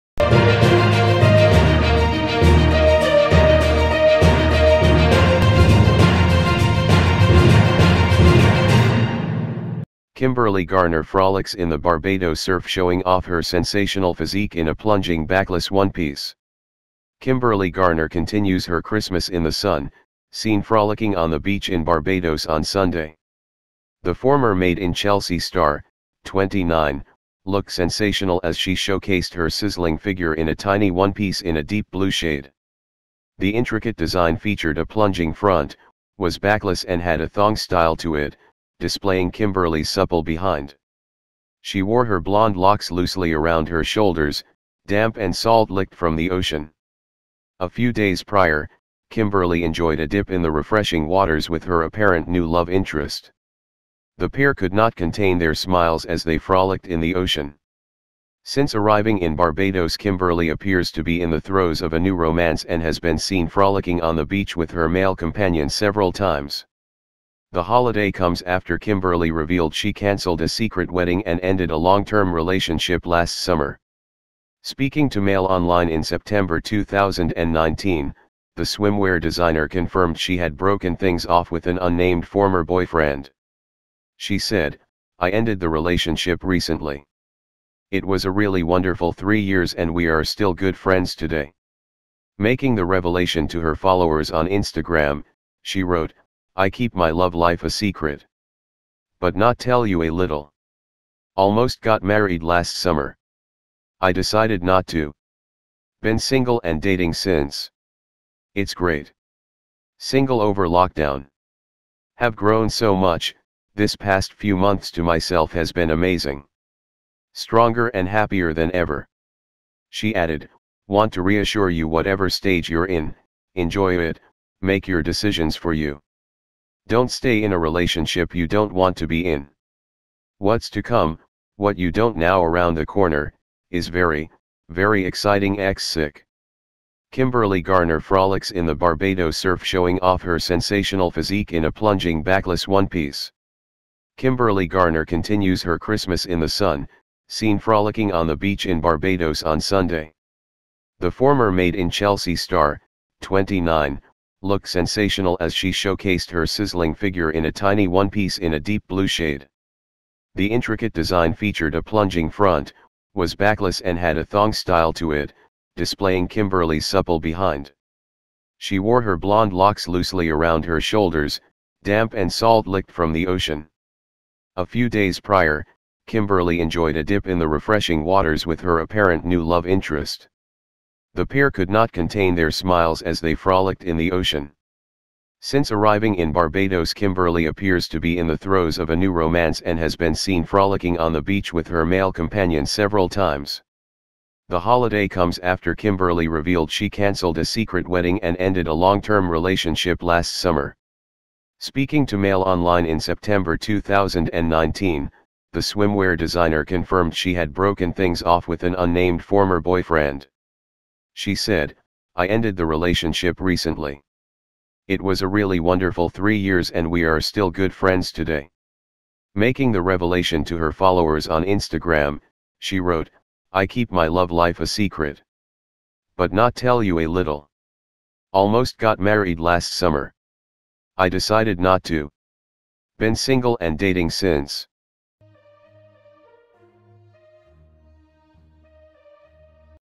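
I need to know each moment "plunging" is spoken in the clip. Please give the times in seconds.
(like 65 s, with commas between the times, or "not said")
14 s, 34 s, 141 s, 161 s.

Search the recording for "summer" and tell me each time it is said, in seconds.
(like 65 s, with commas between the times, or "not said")
73 s, 102 s, 200 s, 229 s.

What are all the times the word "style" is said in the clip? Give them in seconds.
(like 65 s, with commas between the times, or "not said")
37 s, 164 s.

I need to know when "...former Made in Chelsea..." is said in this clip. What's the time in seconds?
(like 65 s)
151 s.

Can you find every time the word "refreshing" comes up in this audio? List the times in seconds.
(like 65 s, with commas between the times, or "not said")
50 s, 177 s.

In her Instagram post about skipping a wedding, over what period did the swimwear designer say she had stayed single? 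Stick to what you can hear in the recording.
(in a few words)
lockdown.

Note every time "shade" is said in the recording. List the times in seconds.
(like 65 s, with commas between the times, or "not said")
32 s, 159 s.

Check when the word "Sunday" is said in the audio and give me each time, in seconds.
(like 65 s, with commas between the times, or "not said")
22 s, 149 s.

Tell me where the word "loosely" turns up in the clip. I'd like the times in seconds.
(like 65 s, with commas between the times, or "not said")
42 s, 169 s.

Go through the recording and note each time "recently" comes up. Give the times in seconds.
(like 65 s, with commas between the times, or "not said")
86 s, 213 s.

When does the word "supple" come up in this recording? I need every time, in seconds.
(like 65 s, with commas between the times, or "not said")
39 s, 166 s.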